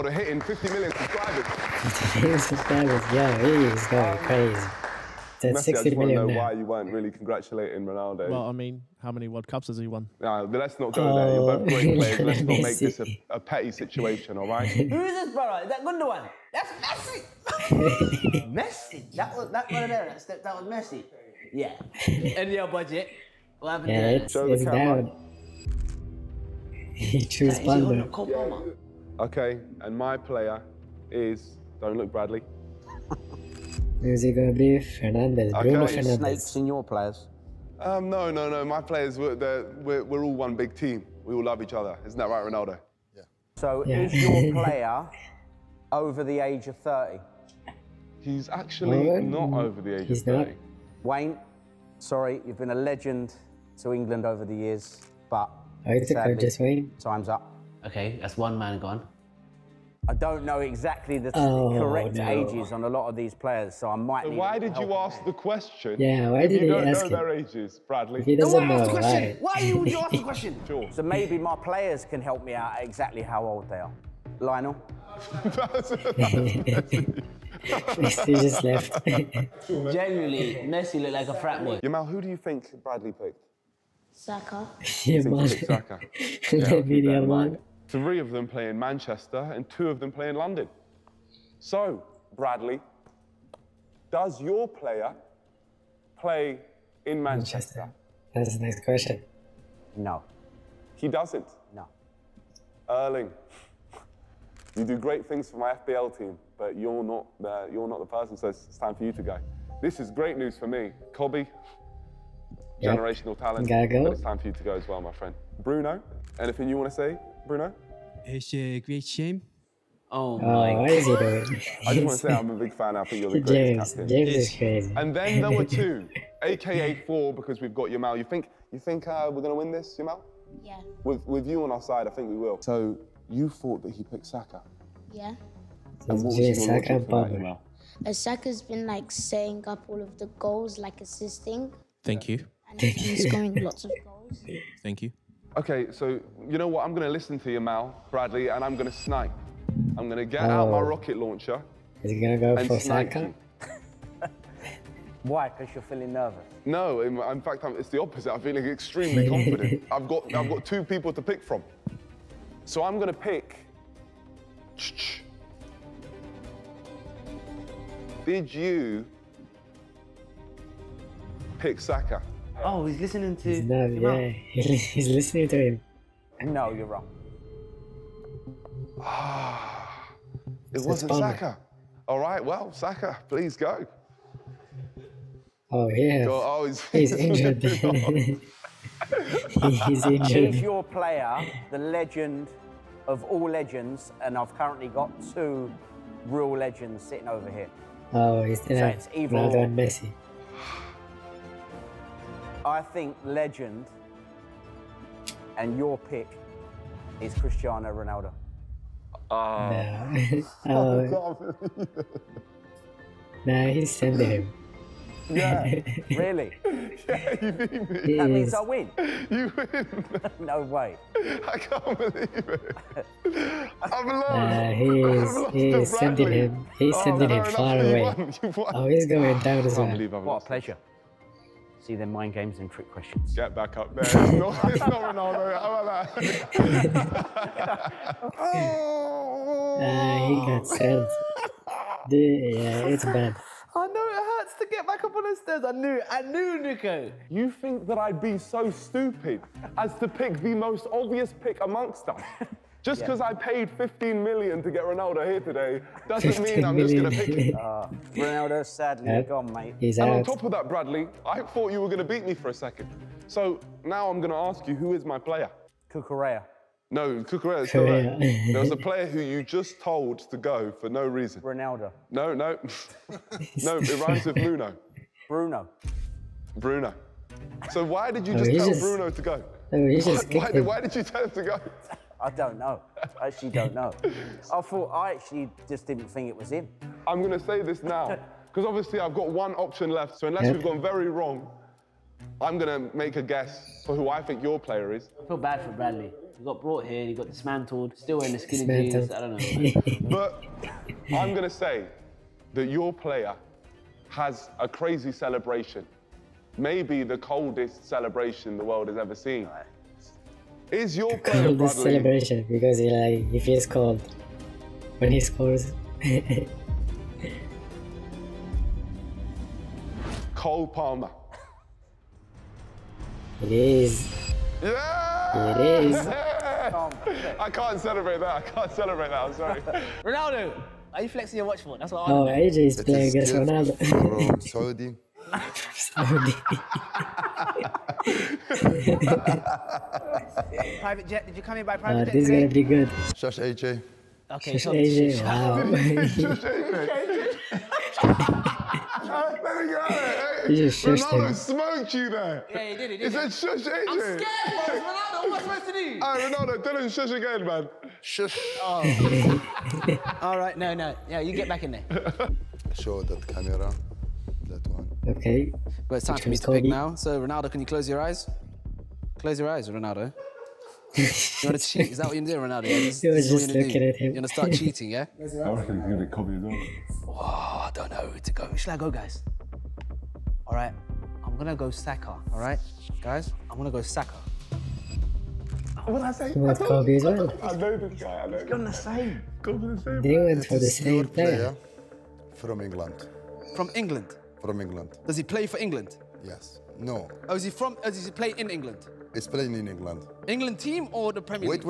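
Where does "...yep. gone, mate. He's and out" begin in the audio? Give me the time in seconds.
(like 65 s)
259 s.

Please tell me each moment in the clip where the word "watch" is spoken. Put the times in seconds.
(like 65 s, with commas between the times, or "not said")
331 s.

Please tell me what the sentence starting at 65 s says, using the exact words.
Yeah, why did you don't ask know their ages, Bradley?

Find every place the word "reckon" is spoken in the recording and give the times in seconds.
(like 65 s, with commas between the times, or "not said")
375 s.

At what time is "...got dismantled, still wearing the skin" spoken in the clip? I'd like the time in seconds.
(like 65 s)
297 s.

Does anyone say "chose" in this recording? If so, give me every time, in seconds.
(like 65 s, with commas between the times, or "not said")
27 s.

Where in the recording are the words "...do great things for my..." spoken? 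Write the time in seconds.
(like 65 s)
104 s.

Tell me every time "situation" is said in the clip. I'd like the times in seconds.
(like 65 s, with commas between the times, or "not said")
13 s.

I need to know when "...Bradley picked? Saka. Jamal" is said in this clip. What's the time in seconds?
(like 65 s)
82 s.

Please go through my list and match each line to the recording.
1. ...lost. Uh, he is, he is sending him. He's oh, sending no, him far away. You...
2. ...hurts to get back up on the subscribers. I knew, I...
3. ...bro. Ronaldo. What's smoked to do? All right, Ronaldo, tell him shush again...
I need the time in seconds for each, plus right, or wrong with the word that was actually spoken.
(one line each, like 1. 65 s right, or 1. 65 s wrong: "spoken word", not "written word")
1. 224 s right
2. 244 s wrong: "stairs", not "subscribers"
3. 354 s wrong: "supposed", not "smoked".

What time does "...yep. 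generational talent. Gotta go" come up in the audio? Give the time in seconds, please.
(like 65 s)
112 s.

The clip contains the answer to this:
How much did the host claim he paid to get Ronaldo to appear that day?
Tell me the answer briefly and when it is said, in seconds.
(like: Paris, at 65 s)
15 million, at 253 s.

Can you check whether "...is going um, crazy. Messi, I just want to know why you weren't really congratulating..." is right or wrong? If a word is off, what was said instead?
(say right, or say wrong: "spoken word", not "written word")
right.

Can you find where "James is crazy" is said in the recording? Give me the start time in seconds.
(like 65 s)
124 s.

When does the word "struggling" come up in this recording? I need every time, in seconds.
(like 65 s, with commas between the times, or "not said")
not said.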